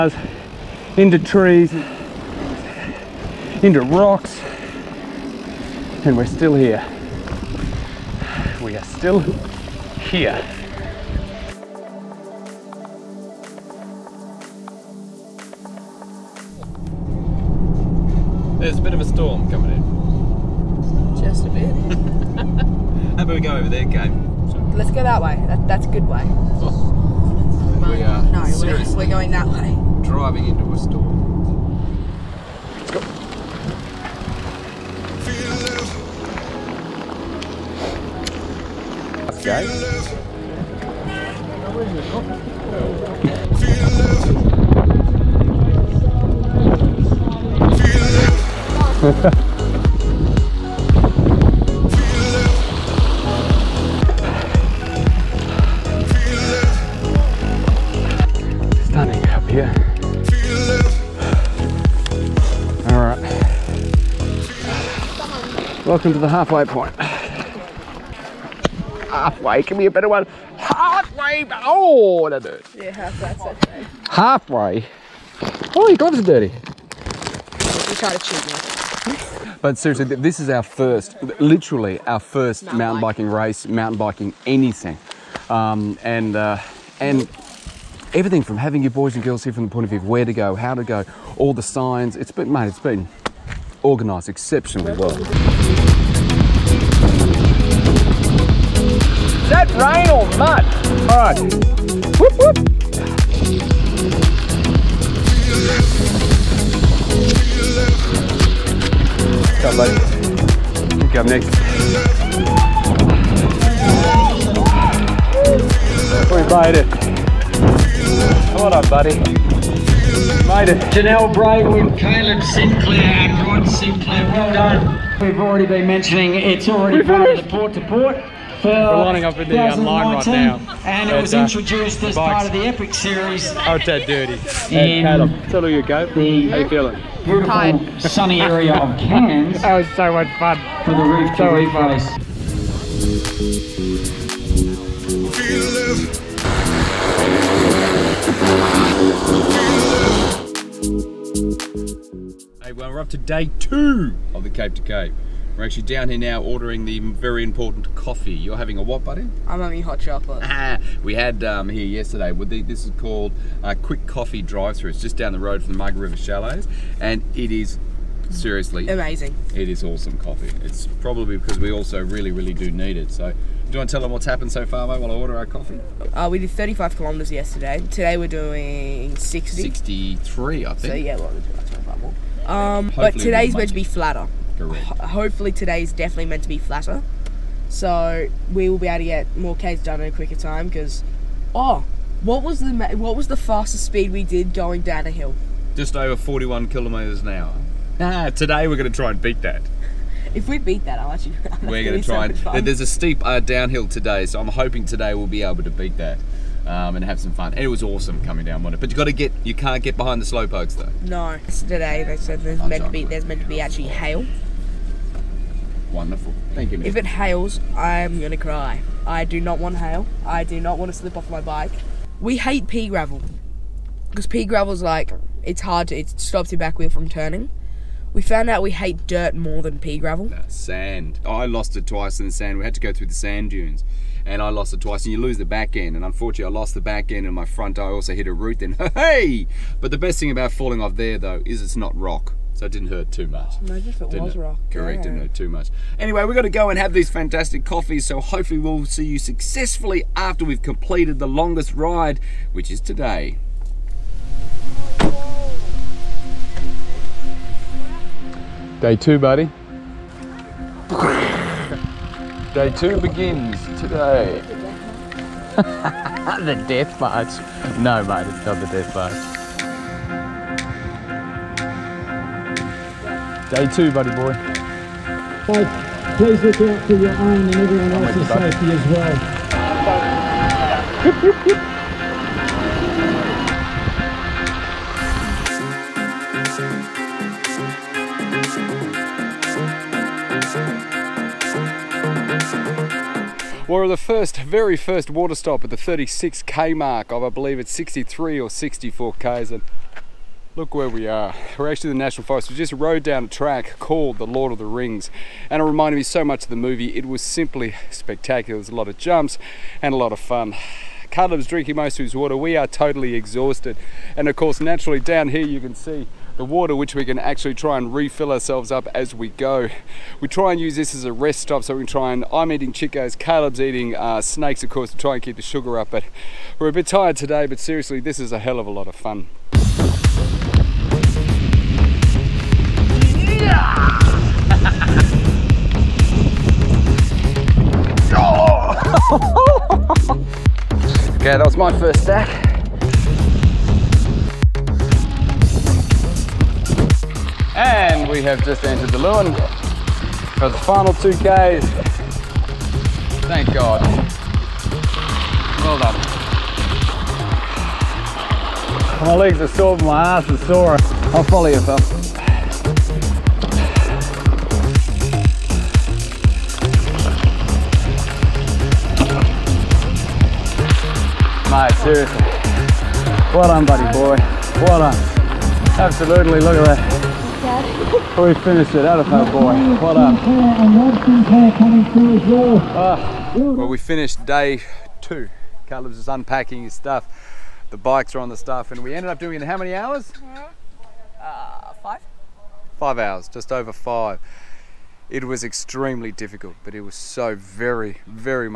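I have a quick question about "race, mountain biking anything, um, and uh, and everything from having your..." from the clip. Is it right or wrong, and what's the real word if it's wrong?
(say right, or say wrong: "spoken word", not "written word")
right.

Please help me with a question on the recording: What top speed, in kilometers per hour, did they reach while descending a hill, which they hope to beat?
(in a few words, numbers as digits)
Just over 41.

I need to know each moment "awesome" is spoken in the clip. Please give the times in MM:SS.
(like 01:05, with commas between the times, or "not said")
02:49, 03:27.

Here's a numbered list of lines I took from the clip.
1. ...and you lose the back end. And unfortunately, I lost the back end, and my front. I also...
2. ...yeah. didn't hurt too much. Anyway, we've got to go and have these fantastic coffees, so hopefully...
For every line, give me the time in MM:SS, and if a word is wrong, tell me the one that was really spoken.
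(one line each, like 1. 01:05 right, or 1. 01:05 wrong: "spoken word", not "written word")
1. 03:55 right
2. 04:04 right.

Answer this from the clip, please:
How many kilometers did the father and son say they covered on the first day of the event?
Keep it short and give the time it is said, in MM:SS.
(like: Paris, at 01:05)
35, at 02:56.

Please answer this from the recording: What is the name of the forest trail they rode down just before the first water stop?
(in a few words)
The Lord of the Rings.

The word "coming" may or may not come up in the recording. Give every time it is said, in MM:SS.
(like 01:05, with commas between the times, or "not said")
00:19, 03:28.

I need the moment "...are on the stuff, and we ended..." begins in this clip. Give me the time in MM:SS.
06:28.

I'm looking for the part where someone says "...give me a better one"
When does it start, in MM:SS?
01:09.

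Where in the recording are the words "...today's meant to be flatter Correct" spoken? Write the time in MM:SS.
03:03.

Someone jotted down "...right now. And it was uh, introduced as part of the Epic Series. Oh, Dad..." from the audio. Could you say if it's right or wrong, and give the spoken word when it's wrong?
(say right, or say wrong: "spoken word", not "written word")
right.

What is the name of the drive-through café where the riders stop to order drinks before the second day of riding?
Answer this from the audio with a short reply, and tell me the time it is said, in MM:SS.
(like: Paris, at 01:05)
Quick Coffee Drive-Through, at 02:43.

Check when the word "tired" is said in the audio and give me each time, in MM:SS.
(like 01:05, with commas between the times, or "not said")
05:26.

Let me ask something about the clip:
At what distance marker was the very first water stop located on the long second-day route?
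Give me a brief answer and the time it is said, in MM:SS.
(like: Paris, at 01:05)
36 km, at 04:55.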